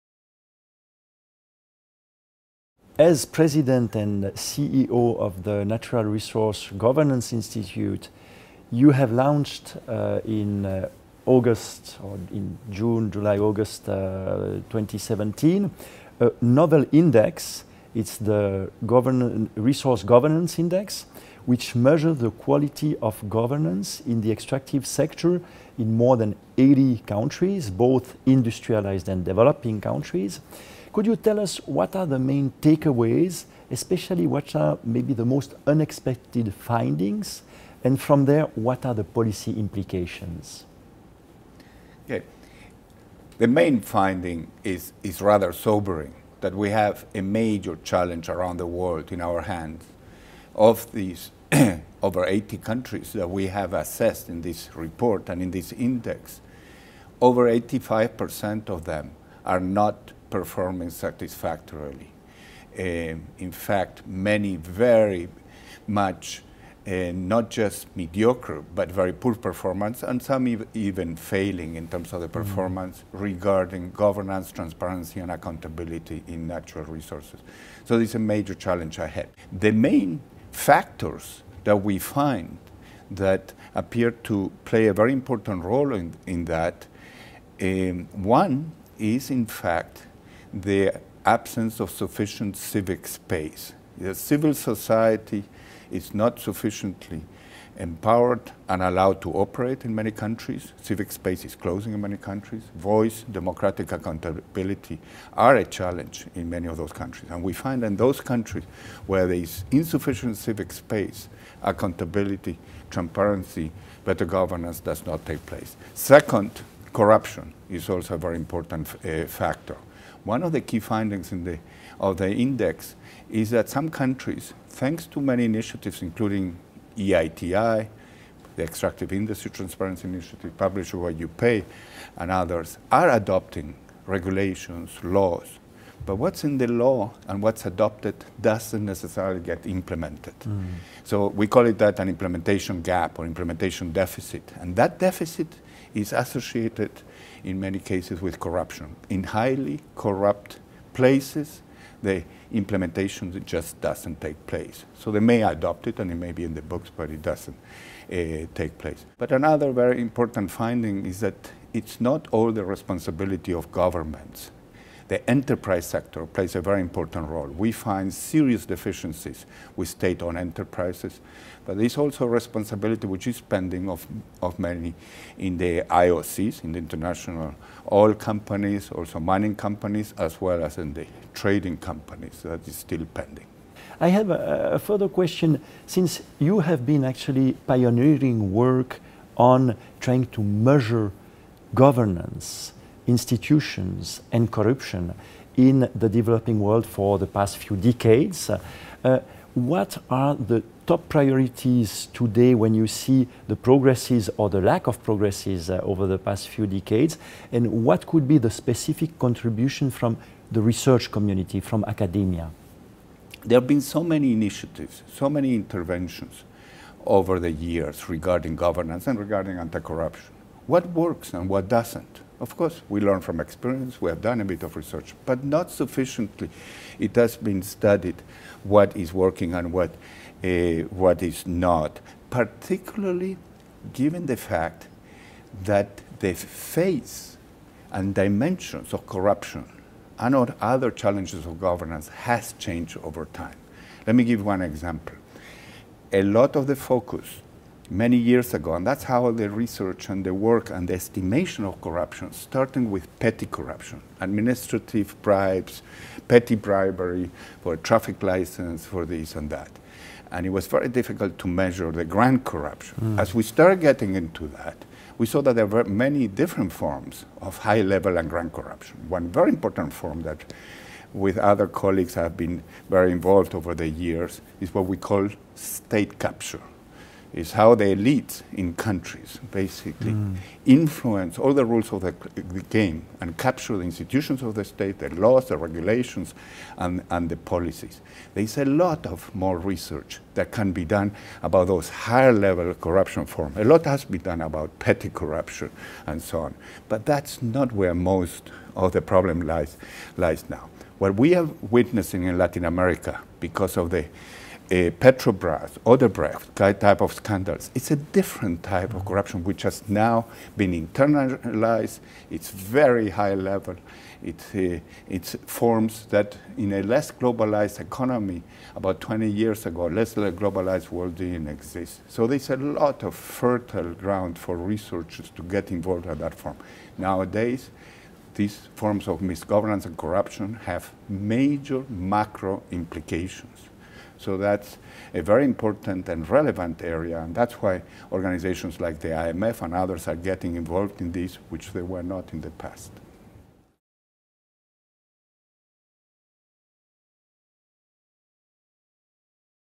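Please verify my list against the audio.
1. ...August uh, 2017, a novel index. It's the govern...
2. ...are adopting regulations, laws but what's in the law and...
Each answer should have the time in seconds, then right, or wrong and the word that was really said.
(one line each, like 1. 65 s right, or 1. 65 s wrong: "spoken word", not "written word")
1. 13 s right
2. 132 s right.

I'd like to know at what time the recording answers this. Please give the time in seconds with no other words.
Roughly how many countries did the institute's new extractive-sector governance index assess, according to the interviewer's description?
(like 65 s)
25 s.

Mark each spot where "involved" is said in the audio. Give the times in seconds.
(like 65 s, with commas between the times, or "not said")
273 s, 325 s, 340 s.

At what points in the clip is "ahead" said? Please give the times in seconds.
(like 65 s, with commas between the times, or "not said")
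79 s.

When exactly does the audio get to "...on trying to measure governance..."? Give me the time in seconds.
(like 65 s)
189 s.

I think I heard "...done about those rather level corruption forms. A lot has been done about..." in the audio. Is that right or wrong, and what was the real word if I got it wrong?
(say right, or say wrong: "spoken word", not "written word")
wrong: "higher", not "rather".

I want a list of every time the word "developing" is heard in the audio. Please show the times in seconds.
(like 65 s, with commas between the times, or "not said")
29 s, 196 s.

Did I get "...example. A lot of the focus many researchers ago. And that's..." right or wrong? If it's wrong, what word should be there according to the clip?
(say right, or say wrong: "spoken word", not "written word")
wrong: "years", not "researchers".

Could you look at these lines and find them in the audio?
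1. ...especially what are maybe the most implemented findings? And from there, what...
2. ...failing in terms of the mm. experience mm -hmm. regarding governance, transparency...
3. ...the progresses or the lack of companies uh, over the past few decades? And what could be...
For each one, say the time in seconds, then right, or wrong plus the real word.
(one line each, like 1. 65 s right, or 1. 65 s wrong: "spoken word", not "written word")
1. 33 s wrong: "unexpected", not "implemented"
2. 71 s wrong: "performance", not "experience"
3. 203 s wrong: "progresses", not "companies".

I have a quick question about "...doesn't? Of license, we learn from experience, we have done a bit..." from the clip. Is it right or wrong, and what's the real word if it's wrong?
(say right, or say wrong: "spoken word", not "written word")
wrong: "course", not "license".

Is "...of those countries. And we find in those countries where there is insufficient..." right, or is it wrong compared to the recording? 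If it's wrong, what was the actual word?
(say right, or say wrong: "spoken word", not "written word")
right.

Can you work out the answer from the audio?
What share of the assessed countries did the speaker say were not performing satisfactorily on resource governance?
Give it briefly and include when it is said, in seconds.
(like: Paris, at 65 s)
over 85%, at 57 s.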